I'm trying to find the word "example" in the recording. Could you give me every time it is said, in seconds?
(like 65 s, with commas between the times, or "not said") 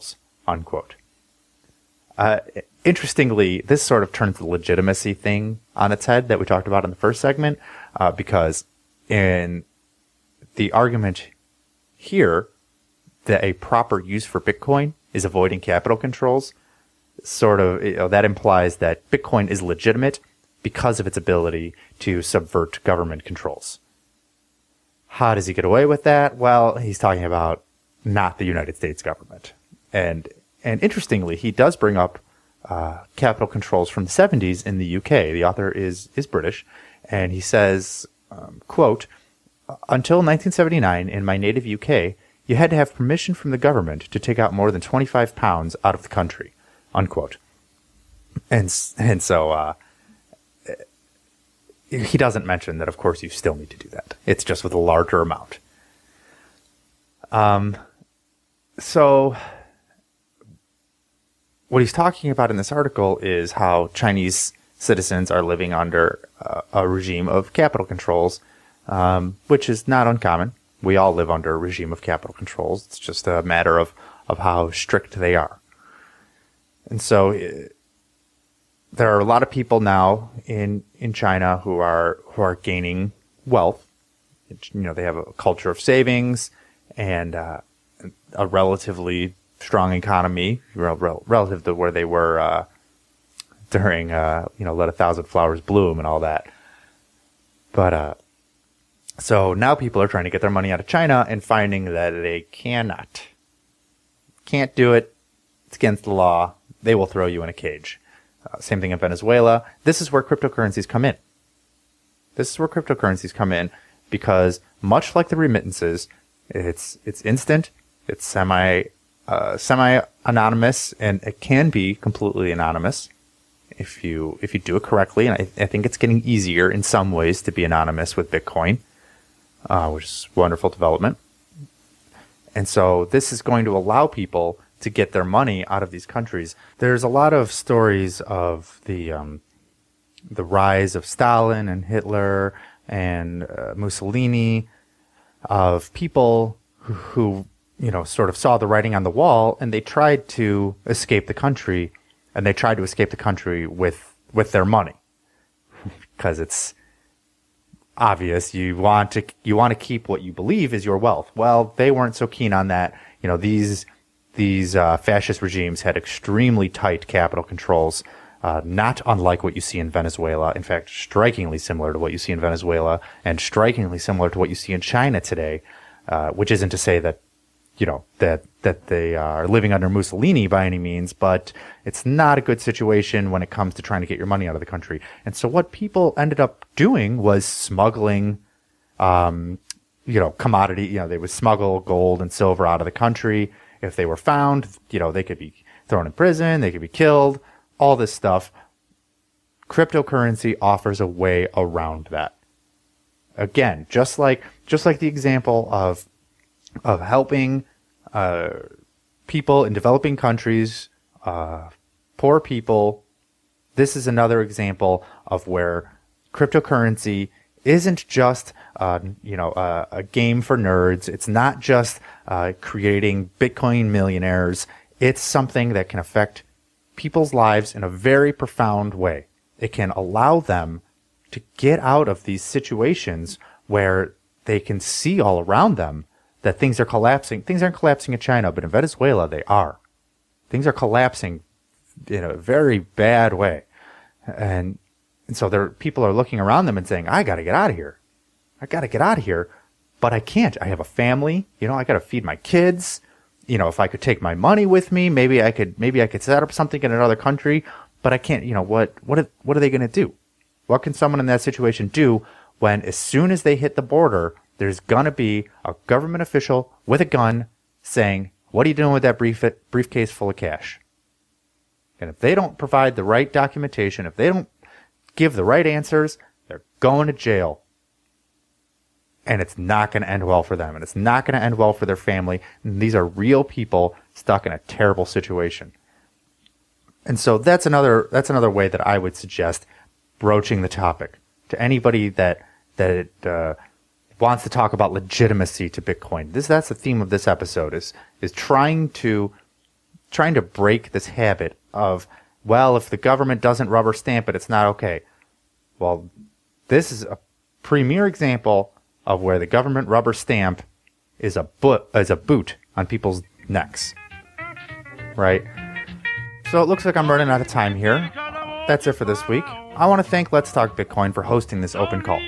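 205 s, 214 s, 308 s.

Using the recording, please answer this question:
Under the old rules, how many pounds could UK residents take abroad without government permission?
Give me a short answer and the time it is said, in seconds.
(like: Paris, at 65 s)
25 pounds, at 44 s.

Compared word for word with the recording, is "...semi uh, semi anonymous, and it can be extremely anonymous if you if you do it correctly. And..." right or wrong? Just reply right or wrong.
wrong.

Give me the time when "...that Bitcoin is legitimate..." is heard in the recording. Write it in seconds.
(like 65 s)
18 s.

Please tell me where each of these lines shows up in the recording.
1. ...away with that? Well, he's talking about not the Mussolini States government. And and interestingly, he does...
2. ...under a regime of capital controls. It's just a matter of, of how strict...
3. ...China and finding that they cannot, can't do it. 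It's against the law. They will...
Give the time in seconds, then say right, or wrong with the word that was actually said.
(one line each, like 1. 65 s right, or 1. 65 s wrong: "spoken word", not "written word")
1. 25 s wrong: "United", not "Mussolini"
2. 71 s right
3. 100 s right.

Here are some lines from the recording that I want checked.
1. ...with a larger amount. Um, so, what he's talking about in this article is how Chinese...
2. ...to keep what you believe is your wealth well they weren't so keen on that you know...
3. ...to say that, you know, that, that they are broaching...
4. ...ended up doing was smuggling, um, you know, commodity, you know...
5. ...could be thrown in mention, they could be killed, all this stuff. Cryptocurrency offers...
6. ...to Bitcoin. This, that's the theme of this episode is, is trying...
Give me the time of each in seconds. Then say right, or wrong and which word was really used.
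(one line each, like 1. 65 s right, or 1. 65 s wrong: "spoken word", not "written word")
1. 54 s right
2. 159 s right
3. 176 s wrong: "living", not "broaching"
4. 186 s right
5. 195 s wrong: "prison", not "mention"
6. 295 s right.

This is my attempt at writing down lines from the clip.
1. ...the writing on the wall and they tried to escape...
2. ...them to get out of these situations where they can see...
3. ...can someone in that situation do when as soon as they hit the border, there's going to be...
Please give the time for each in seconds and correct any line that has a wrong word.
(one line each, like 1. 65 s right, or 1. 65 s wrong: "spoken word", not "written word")
1. 148 s right
2. 230 s right
3. 260 s right.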